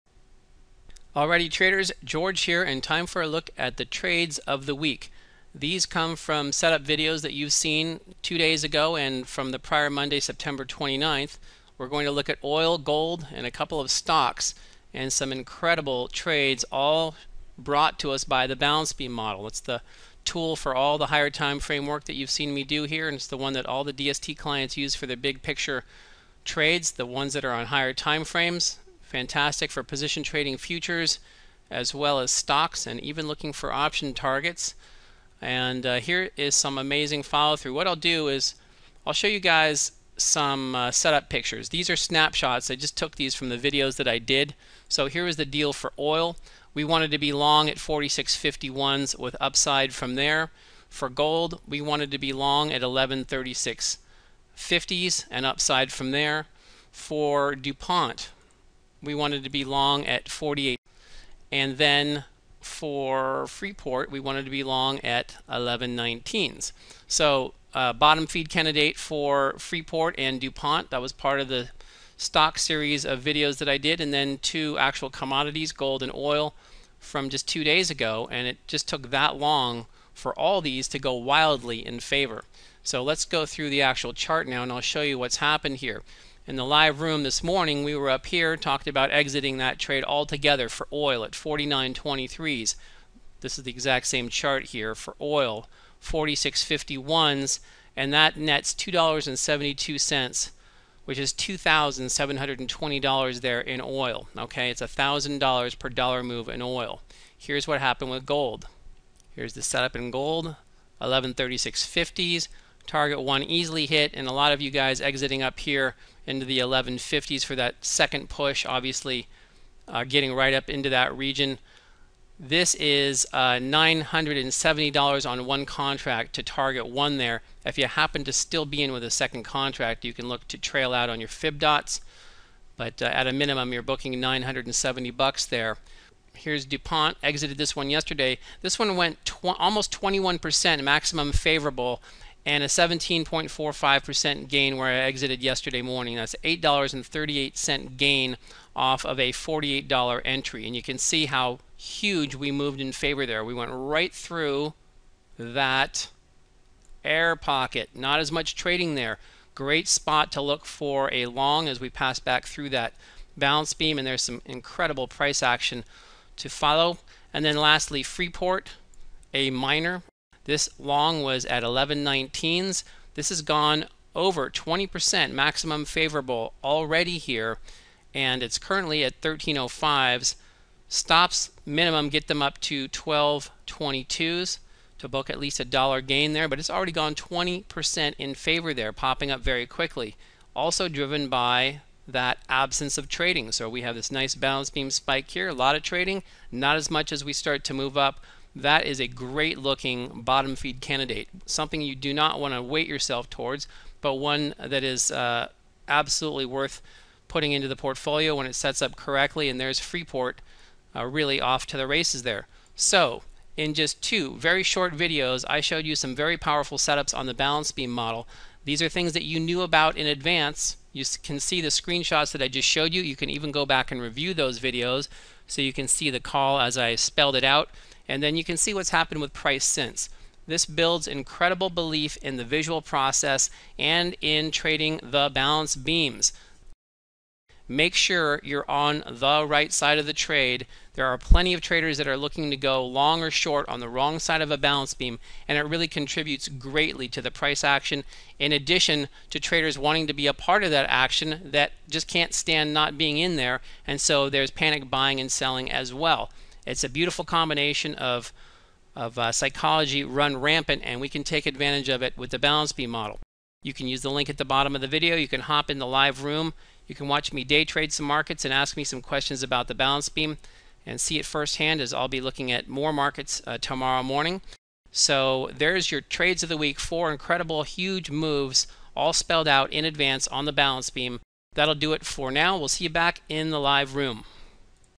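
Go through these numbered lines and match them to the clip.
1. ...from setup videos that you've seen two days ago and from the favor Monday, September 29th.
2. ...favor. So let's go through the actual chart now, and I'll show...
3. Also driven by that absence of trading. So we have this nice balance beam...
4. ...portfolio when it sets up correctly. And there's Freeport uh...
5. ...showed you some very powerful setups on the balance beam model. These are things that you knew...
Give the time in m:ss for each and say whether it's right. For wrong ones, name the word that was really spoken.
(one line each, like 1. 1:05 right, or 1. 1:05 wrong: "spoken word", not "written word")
1. 0:06 wrong: "prior", not "favor"
2. 1:21 right
3. 3:10 right
4. 3:27 right
5. 3:35 right.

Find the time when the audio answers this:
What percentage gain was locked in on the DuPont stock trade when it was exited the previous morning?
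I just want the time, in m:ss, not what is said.
2:22.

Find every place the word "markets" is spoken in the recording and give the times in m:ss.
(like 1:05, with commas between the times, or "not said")
4:28, 4:32.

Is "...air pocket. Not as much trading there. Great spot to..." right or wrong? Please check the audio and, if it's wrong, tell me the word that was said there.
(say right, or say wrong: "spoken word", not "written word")
right.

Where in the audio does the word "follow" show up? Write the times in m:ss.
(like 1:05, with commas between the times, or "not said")
0:37, 2:46.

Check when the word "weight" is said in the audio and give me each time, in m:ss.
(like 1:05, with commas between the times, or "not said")
3:22.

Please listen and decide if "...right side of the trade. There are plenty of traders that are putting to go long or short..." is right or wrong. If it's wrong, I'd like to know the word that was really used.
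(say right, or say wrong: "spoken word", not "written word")
wrong: "looking", not "putting".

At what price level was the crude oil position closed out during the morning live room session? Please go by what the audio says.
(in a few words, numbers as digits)
49.23.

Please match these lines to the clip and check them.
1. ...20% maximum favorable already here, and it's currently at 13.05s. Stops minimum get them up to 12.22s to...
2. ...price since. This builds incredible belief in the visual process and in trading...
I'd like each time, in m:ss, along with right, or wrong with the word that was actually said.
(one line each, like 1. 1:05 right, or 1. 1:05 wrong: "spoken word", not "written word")
1. 2:54 right
2. 3:49 right.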